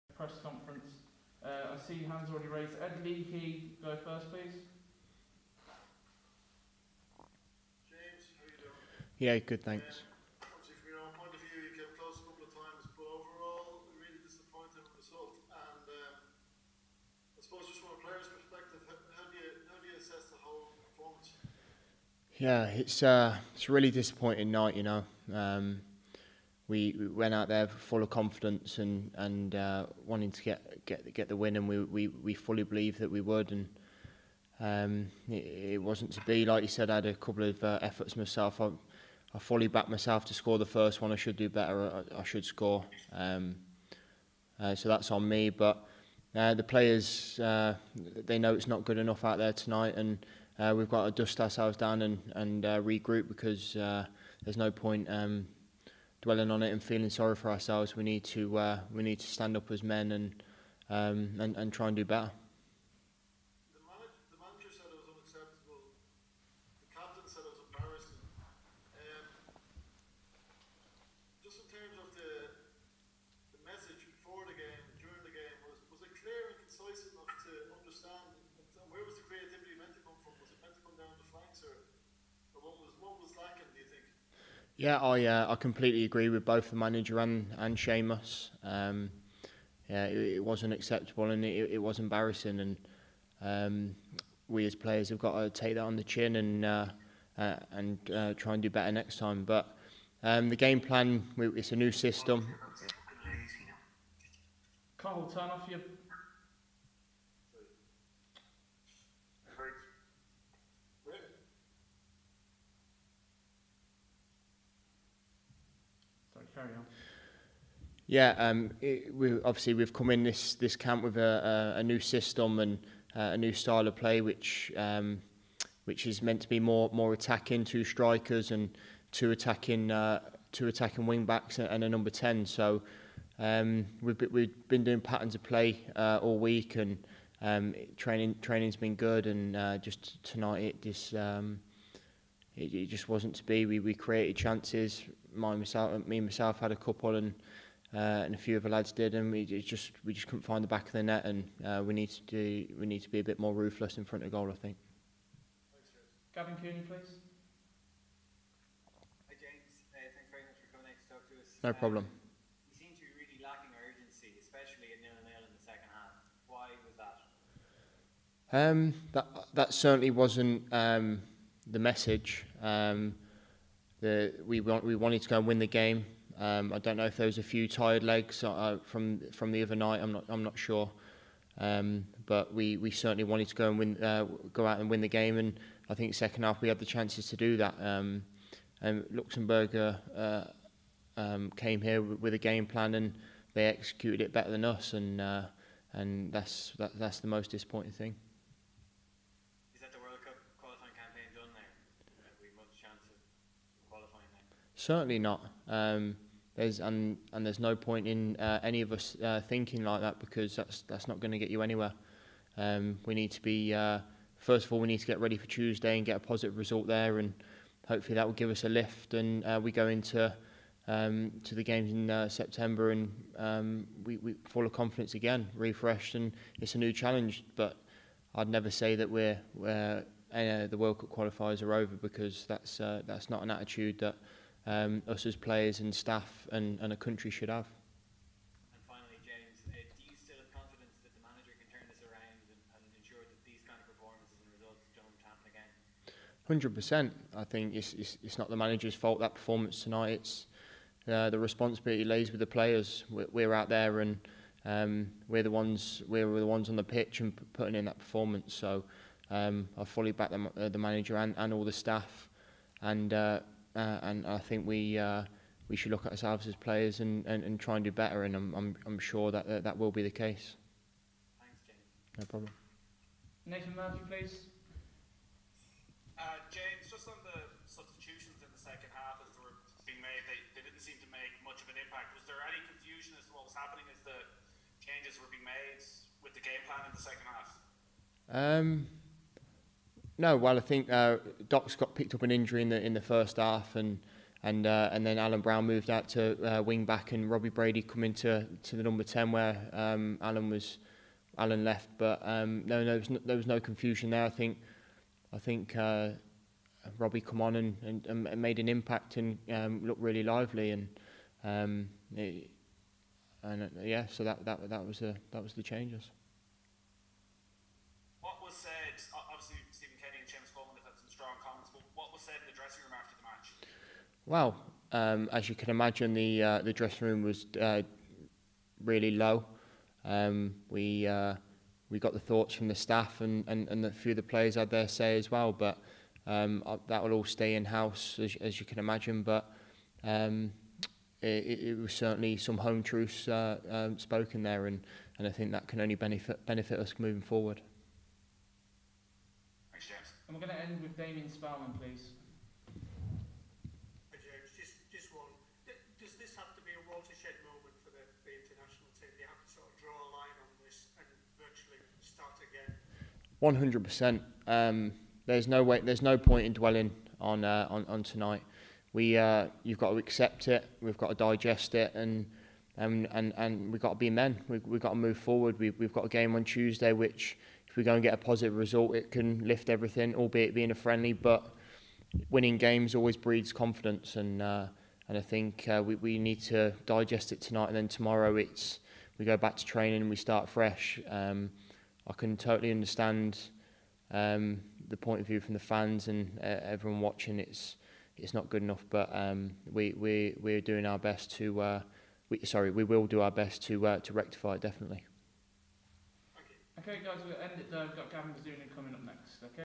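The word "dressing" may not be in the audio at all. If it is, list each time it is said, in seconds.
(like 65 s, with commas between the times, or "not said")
322 s, 326 s.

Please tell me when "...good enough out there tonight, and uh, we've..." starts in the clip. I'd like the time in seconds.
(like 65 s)
48 s.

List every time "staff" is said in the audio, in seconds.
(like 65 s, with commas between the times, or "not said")
235 s, 261 s, 332 s.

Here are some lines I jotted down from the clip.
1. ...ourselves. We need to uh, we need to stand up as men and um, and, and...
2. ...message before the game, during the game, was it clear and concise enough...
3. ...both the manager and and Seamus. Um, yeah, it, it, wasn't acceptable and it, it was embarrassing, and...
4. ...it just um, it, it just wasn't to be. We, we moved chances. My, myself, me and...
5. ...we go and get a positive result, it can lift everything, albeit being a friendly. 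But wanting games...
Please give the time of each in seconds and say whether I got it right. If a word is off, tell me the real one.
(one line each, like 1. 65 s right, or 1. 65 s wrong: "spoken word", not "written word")
1. 57 s right
2. 73 s right
3. 86 s right
4. 140 s wrong: "created", not "moved"
5. 377 s wrong: "winning", not "wanting".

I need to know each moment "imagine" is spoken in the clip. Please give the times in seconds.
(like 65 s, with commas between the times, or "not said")
325 s, 338 s.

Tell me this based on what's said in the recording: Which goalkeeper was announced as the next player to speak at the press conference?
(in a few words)
Gavin Bazunu.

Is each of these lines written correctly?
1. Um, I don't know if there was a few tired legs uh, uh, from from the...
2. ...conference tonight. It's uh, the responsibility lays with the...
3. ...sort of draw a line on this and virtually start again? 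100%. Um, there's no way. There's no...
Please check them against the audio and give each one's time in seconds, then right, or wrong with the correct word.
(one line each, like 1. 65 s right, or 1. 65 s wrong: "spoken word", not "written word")
1. 176 s right
2. 249 s wrong: "performance", not "conference"
3. 359 s right.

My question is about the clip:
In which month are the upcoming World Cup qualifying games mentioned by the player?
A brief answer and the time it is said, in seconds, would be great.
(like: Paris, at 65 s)
September, at 222 s.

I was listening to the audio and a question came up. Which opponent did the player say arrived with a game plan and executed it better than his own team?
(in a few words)
Luxembourg.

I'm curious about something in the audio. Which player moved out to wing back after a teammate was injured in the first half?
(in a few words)
Alan Browne.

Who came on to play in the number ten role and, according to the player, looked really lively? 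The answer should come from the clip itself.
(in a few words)
Robbie Brady.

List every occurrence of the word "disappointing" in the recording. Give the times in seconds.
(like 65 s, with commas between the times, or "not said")
23 s, 197 s.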